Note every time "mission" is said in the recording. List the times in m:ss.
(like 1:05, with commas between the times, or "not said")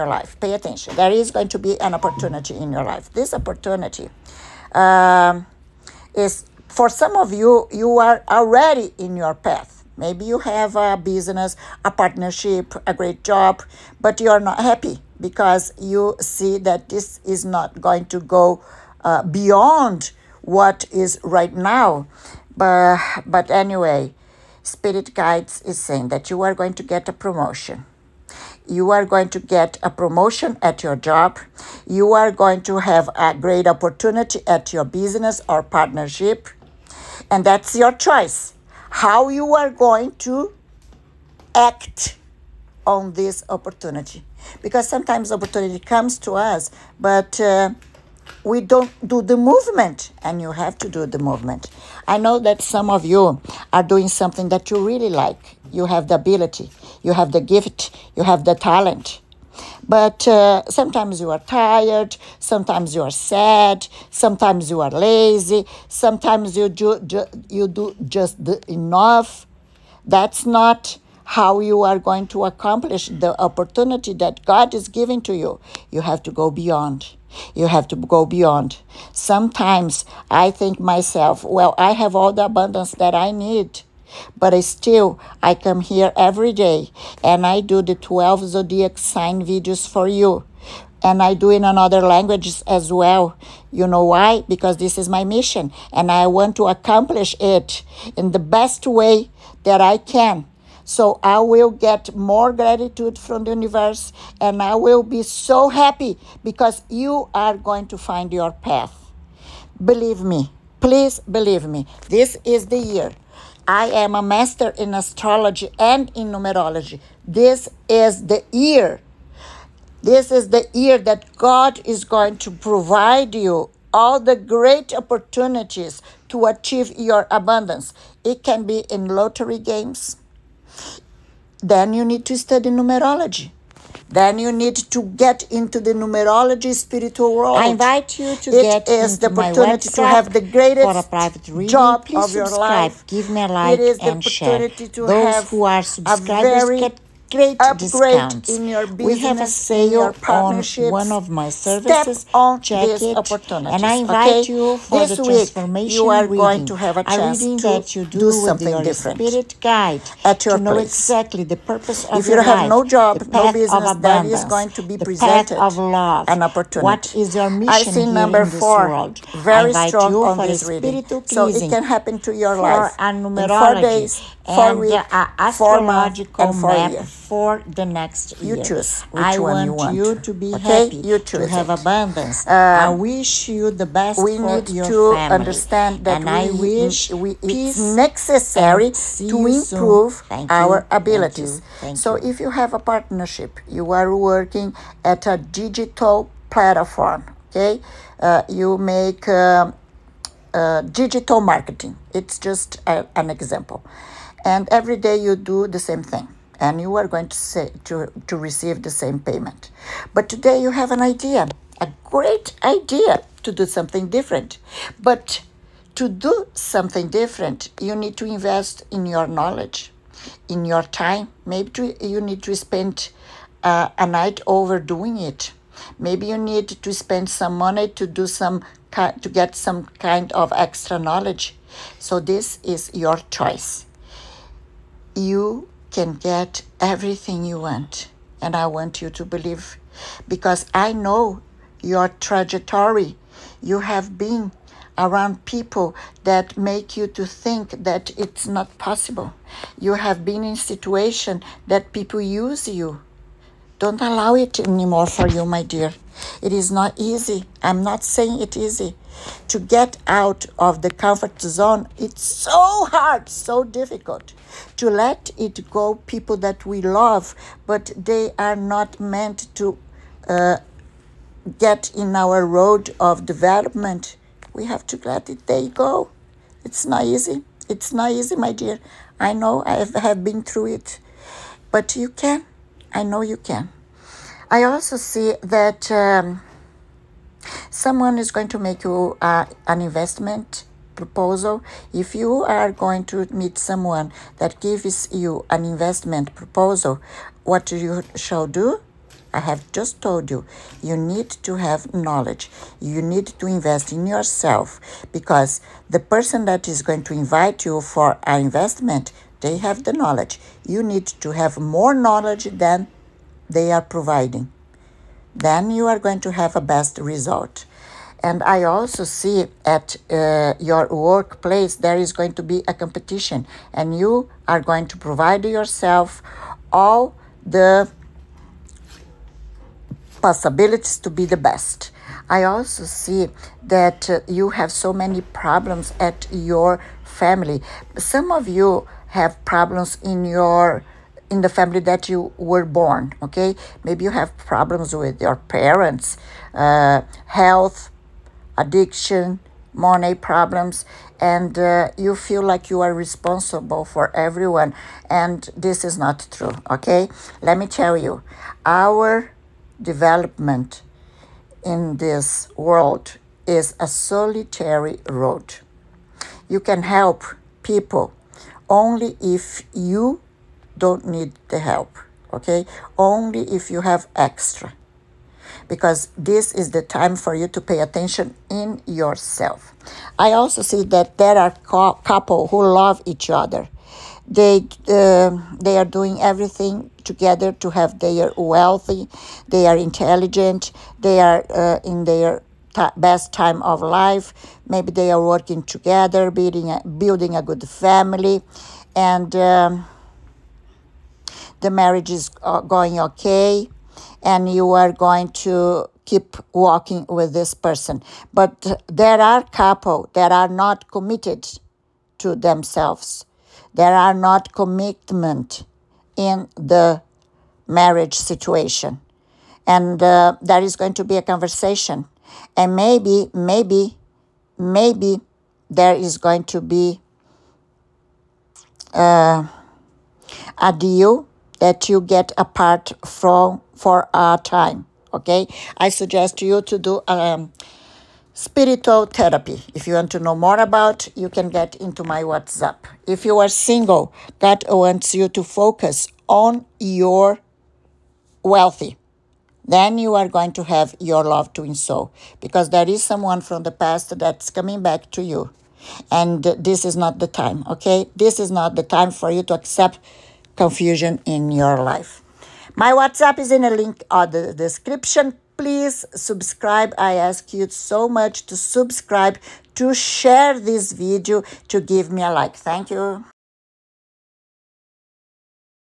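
1:35, 2:47.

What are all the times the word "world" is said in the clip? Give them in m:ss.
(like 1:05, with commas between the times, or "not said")
2:17, 2:48, 6:02.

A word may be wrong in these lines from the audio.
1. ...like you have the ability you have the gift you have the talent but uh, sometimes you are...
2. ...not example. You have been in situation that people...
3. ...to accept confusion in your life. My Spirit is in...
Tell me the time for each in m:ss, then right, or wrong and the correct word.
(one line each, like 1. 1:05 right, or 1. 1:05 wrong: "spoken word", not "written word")
1. 0:55 right
2. 4:08 wrong: "possible", not "example"
3. 7:39 wrong: "WhatsApp", not "Spirit".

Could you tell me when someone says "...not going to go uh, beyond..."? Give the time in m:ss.
0:17.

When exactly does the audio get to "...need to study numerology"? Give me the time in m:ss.
2:12.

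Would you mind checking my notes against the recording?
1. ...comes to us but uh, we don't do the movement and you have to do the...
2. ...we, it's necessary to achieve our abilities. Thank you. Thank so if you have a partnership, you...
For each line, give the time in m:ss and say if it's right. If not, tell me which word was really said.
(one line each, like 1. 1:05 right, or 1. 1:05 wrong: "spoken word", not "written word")
1. 0:45 right
2. 3:07 wrong: "improve", not "achieve".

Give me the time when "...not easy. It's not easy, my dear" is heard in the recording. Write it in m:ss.
4:36.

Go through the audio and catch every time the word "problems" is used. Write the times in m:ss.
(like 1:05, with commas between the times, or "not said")
5:35, 5:39, 5:44, 5:50.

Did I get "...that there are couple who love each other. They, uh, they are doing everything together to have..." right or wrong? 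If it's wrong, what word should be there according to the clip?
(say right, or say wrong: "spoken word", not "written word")
right.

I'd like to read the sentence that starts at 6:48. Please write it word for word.
But there are couple that are not committed to themselves.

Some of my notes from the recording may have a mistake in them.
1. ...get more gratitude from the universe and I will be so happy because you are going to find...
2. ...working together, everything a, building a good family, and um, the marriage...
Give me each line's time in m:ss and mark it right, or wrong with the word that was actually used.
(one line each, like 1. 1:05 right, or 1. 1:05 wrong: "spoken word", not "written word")
1. 1:41 right
2. 6:35 wrong: "building", not "everything".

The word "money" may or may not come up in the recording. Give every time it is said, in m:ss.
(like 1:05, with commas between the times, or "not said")
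3:47, 5:49.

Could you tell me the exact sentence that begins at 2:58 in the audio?
choose which I one you want.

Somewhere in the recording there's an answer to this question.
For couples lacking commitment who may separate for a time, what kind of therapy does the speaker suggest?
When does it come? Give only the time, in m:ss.
7:18.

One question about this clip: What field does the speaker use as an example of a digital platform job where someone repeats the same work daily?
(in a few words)
Digital marketing.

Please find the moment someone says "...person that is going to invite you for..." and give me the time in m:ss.
5:05.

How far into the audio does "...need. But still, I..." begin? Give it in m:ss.
1:23.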